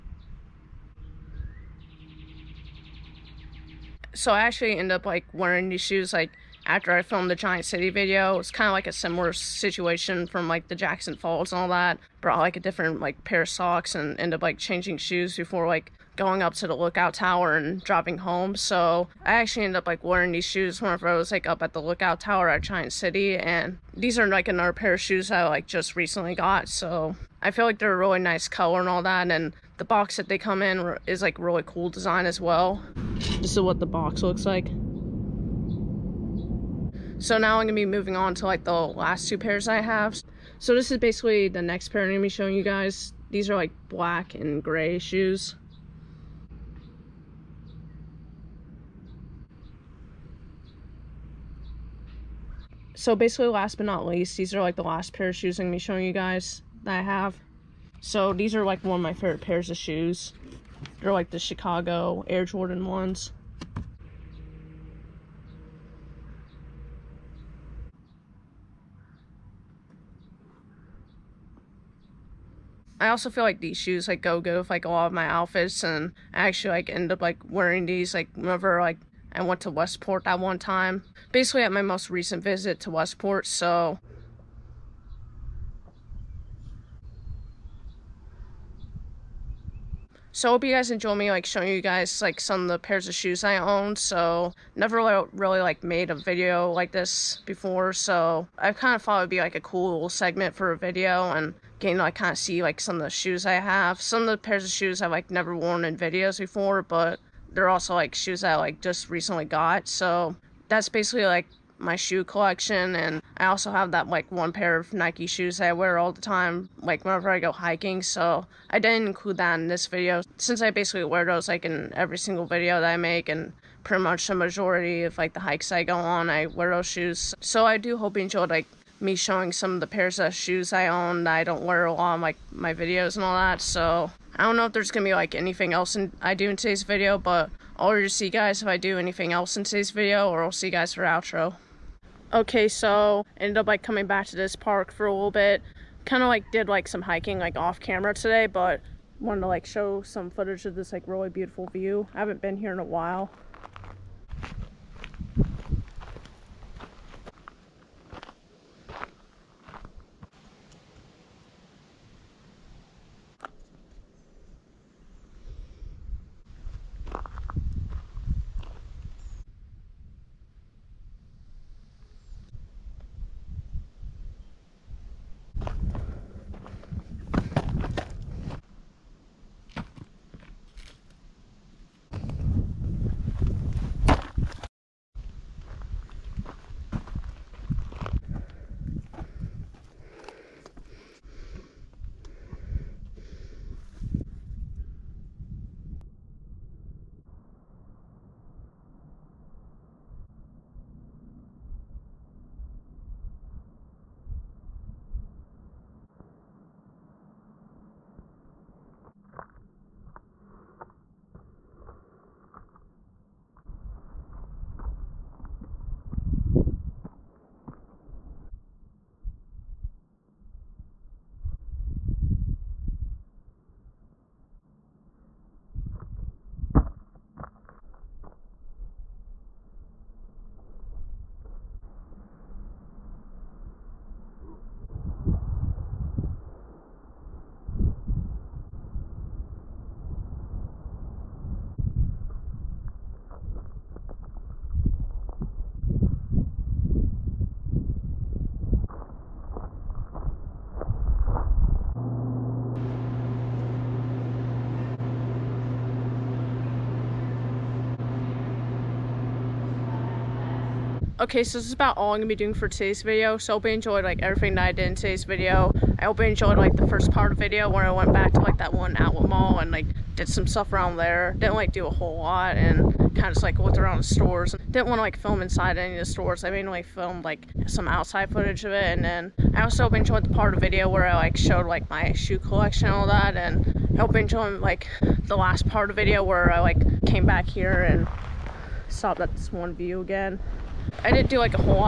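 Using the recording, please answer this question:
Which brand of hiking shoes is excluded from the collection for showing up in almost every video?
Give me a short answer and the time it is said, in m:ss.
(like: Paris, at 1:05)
Nike, at 1:54.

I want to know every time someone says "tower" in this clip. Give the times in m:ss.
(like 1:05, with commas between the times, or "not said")
0:17, 0:22.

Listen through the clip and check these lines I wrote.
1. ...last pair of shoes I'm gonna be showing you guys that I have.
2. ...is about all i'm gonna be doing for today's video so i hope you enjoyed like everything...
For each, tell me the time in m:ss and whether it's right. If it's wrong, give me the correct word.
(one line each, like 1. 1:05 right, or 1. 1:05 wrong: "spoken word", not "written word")
1. 0:54 right
2. 4:21 right.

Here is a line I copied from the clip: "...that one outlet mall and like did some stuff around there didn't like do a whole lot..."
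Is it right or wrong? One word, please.
right.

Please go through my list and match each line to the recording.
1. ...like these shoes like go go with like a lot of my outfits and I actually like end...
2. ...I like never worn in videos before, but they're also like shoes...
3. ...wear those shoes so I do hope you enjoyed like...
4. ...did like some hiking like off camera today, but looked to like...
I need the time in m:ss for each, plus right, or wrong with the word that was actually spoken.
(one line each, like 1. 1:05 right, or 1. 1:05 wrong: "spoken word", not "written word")
1. 1:13 right
2. 1:45 right
3. 2:06 right
4. 2:26 wrong: "wanted", not "looked".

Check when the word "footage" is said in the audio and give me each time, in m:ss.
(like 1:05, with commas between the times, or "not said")
2:30, 4:38.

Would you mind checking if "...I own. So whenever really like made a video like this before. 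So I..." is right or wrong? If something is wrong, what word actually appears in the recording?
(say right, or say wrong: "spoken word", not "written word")
wrong: "never", not "whenever".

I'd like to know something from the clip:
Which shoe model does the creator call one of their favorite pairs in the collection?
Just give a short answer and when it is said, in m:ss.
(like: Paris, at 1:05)
Chicago Air Jordan ones, at 1:01.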